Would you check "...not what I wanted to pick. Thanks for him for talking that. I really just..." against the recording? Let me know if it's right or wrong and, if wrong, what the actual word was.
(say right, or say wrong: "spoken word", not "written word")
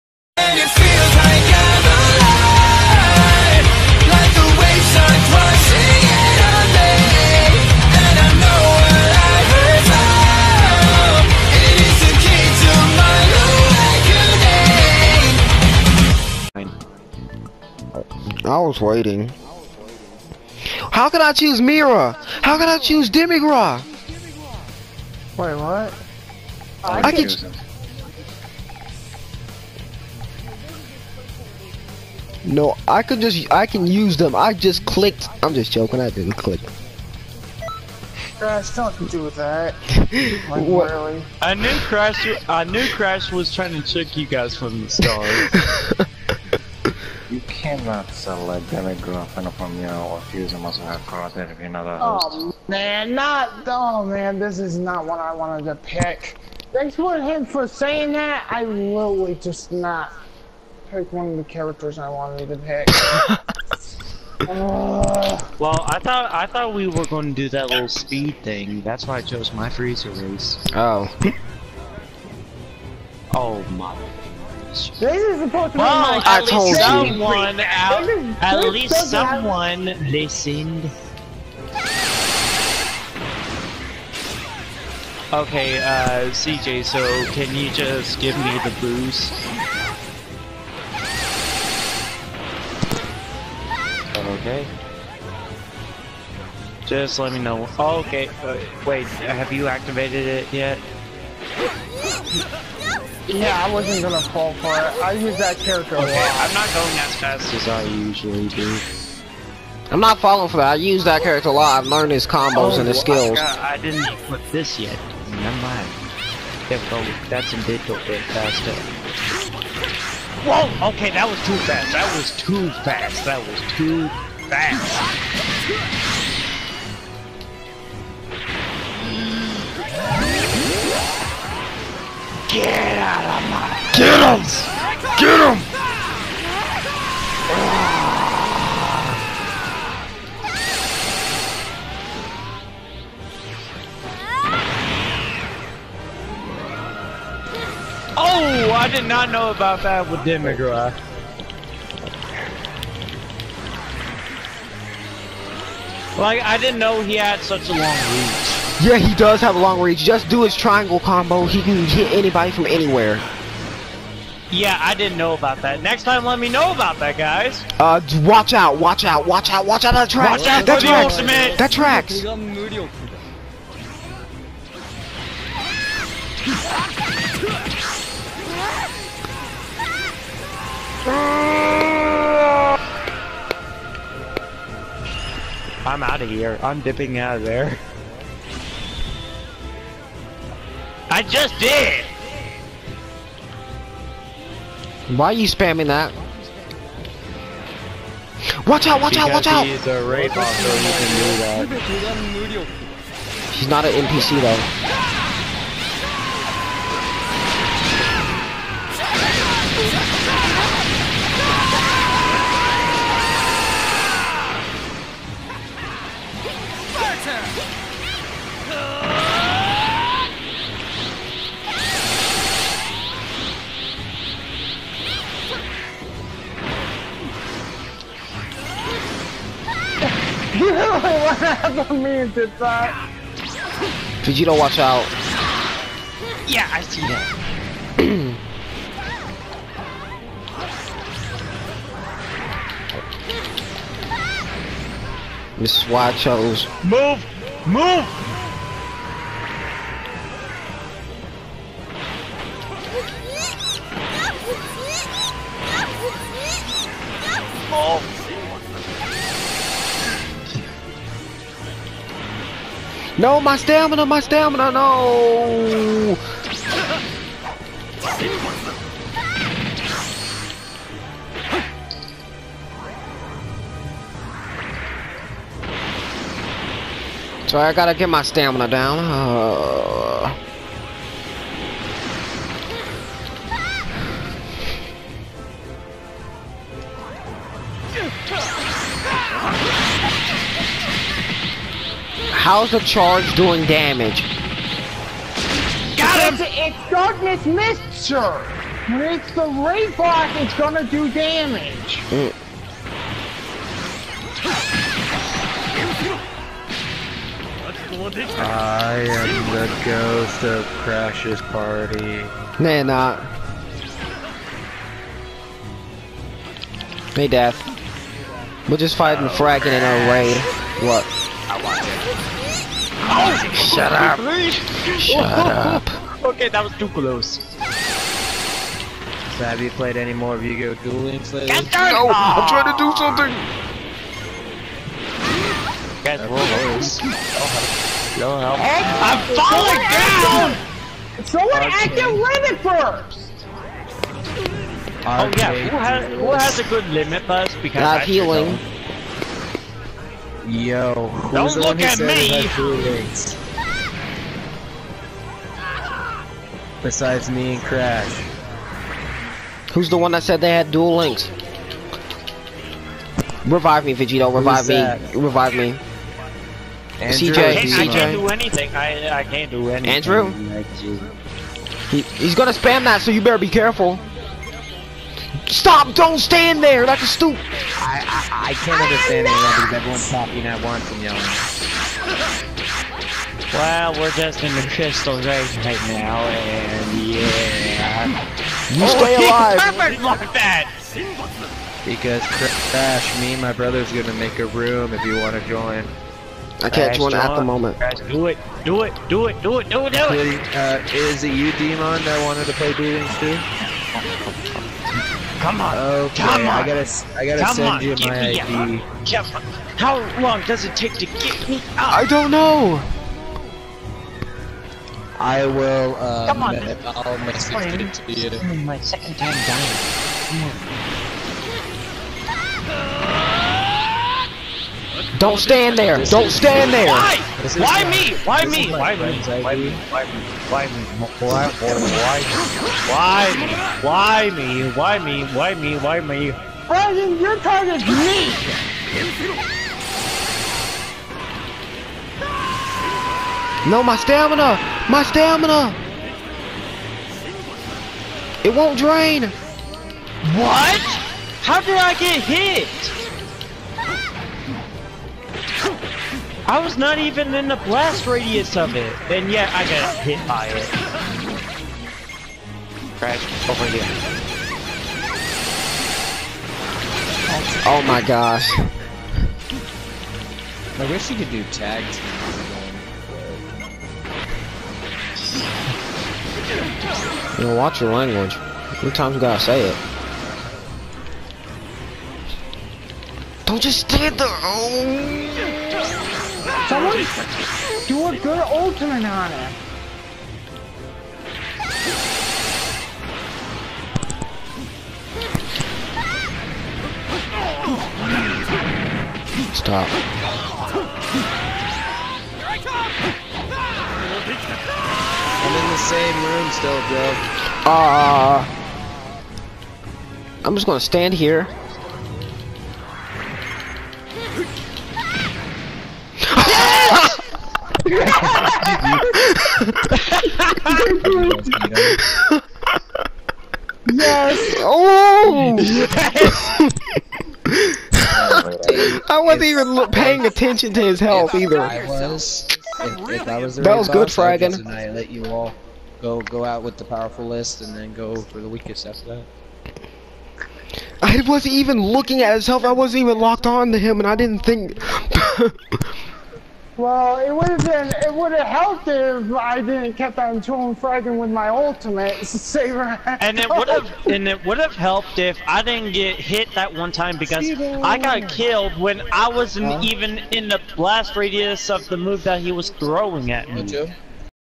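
wrong: "saying", not "talking".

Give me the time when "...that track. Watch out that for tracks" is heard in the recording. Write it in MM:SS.
02:49.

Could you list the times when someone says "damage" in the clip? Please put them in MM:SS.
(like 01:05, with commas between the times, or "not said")
04:53, 05:01.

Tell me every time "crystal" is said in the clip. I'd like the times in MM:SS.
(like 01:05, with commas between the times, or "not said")
06:24.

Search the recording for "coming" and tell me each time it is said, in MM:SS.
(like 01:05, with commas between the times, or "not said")
not said.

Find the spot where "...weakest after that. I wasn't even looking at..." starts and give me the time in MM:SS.
08:58.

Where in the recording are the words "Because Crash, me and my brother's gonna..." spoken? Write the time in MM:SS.
06:31.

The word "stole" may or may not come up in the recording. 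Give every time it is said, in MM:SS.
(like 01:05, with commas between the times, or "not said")
not said.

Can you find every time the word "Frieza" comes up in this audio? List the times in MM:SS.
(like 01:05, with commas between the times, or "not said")
01:09.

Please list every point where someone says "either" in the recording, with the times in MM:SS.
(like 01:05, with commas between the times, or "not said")
08:51.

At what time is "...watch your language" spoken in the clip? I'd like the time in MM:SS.
07:57.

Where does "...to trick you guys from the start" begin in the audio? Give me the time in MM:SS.
00:43.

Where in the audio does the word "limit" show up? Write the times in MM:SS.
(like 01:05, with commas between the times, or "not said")
05:42, 05:46.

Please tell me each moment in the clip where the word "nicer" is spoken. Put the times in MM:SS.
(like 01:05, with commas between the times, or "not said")
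not said.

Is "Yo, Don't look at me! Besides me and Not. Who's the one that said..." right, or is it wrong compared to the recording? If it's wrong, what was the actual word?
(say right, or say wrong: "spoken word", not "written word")
wrong: "Crash", not "Not".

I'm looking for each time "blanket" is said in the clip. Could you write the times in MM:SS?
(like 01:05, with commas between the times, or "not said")
not said.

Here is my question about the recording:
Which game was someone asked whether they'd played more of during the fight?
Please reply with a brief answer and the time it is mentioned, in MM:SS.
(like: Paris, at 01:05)
Vigo Dueling Slayer, at 05:30.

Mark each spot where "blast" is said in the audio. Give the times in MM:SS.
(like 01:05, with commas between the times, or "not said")
07:37, 09:20.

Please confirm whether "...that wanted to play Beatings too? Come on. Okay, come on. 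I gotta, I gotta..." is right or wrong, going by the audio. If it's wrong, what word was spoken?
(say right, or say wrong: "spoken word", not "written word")
right.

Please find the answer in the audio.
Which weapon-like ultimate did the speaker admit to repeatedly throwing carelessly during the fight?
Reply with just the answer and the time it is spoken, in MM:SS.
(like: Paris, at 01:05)
Saber, at 09:12.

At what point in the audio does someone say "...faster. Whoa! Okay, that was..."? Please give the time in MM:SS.
01:58.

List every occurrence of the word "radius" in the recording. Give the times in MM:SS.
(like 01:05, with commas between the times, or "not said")
07:38, 09:21.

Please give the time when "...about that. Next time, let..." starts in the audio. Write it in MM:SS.
02:45.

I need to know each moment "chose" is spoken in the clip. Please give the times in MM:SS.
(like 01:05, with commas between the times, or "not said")
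01:09, 04:06.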